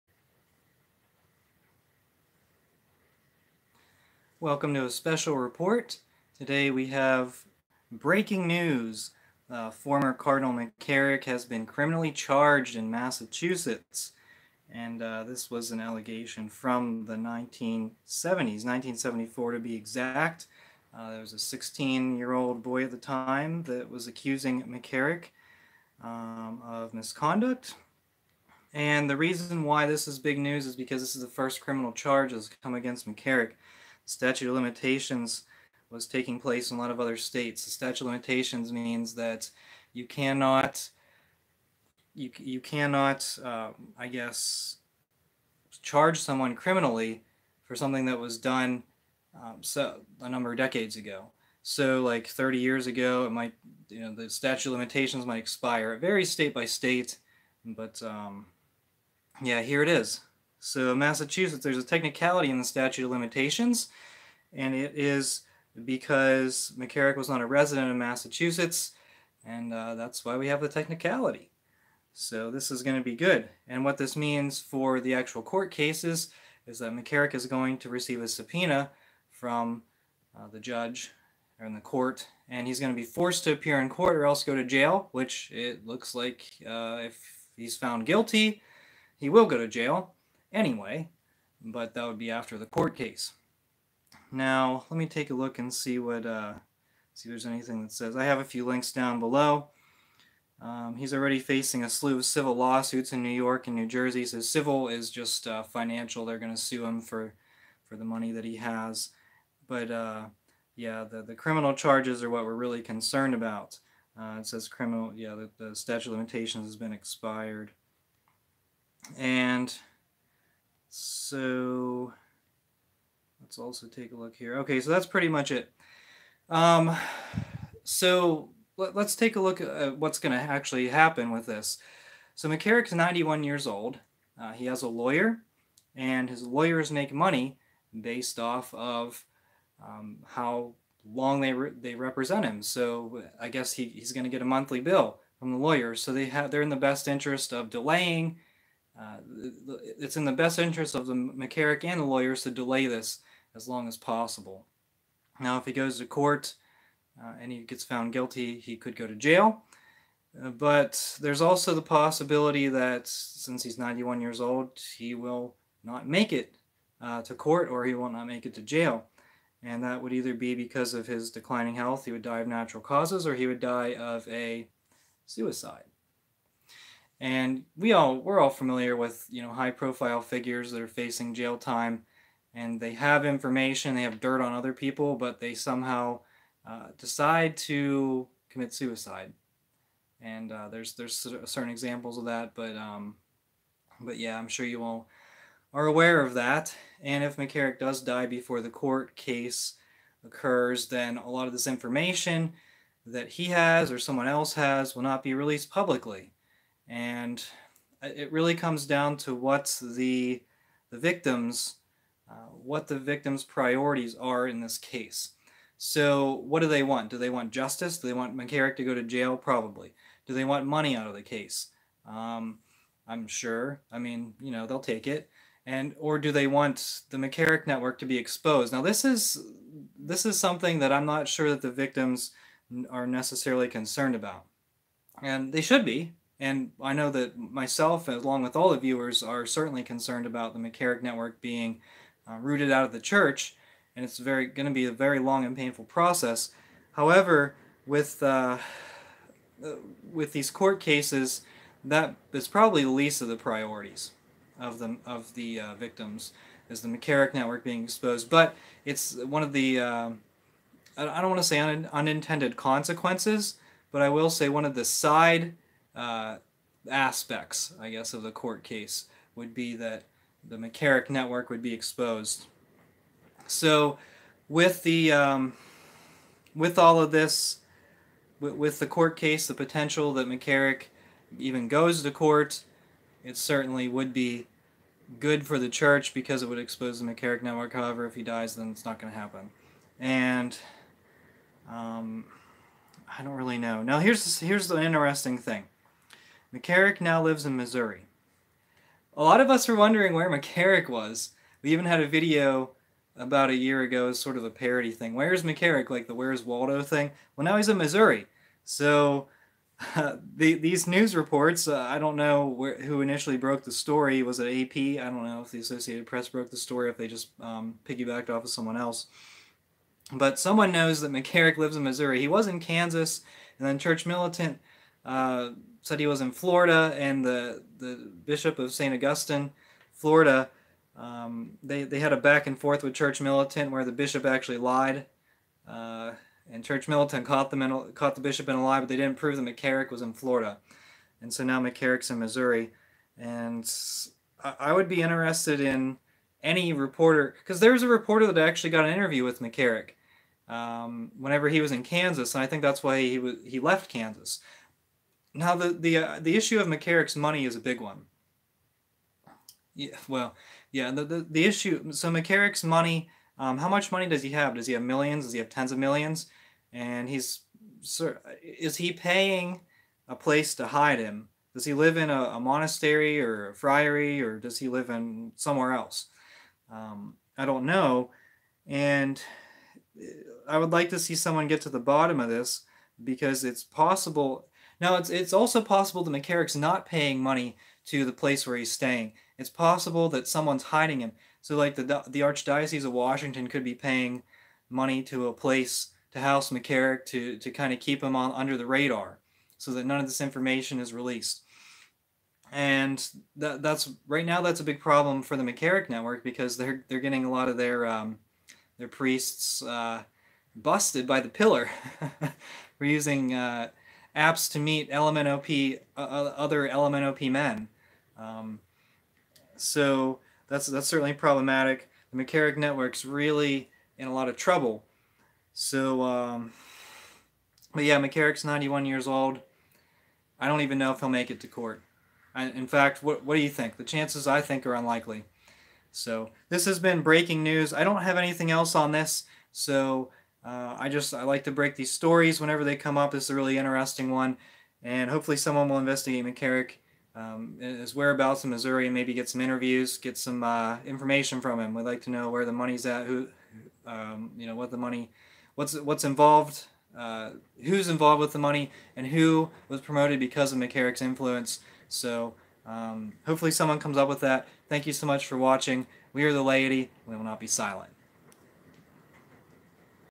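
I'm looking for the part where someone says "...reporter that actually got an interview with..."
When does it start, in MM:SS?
05:47.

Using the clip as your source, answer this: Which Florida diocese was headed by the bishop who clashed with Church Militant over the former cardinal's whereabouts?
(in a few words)
St. Augustine.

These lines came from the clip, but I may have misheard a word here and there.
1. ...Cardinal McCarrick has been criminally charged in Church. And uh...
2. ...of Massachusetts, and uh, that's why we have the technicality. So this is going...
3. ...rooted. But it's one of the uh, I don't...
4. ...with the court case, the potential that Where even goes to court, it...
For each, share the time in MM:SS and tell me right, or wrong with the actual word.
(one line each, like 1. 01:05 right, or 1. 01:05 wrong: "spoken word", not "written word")
1. 00:10 wrong: "Massachusetts", not "Church"
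2. 01:07 right
3. 04:17 wrong: "exposed", not "rooted"
4. 04:38 wrong: "McCarrick", not "Where".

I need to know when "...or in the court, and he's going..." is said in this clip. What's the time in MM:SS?
01:21.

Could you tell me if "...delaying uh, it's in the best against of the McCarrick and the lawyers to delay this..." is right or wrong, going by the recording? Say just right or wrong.
wrong.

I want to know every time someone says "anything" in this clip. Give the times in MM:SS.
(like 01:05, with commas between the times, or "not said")
01:37, 07:18.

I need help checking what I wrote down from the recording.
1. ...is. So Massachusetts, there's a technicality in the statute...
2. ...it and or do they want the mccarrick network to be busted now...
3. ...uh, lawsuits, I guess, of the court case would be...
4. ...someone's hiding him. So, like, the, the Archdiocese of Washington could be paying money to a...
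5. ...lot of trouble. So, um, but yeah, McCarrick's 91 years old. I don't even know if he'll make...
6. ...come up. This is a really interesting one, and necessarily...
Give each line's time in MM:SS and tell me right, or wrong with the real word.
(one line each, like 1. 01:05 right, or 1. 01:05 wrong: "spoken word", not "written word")
1. 00:59 right
2. 03:45 wrong: "exposed", not "busted"
3. 04:25 wrong: "aspects", not "lawsuits"
4. 06:30 right
5. 07:04 right
6. 07:22 wrong: "hopefully", not "necessarily".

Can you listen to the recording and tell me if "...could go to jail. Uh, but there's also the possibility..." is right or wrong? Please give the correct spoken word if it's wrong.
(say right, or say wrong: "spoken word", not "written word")
right.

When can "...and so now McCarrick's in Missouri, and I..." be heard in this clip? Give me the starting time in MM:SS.
05:41.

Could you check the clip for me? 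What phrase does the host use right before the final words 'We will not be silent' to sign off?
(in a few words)
We are the laity.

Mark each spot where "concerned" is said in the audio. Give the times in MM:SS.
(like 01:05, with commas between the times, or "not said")
01:52, 03:53, 03:59.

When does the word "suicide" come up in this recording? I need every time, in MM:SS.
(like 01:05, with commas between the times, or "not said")
02:55, 03:08.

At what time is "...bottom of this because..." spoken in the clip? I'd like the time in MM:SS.
06:21.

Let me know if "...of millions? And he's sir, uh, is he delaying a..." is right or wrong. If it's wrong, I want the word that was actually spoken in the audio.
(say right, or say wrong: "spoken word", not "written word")
wrong: "paying", not "delaying".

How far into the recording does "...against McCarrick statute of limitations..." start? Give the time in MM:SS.
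00:32.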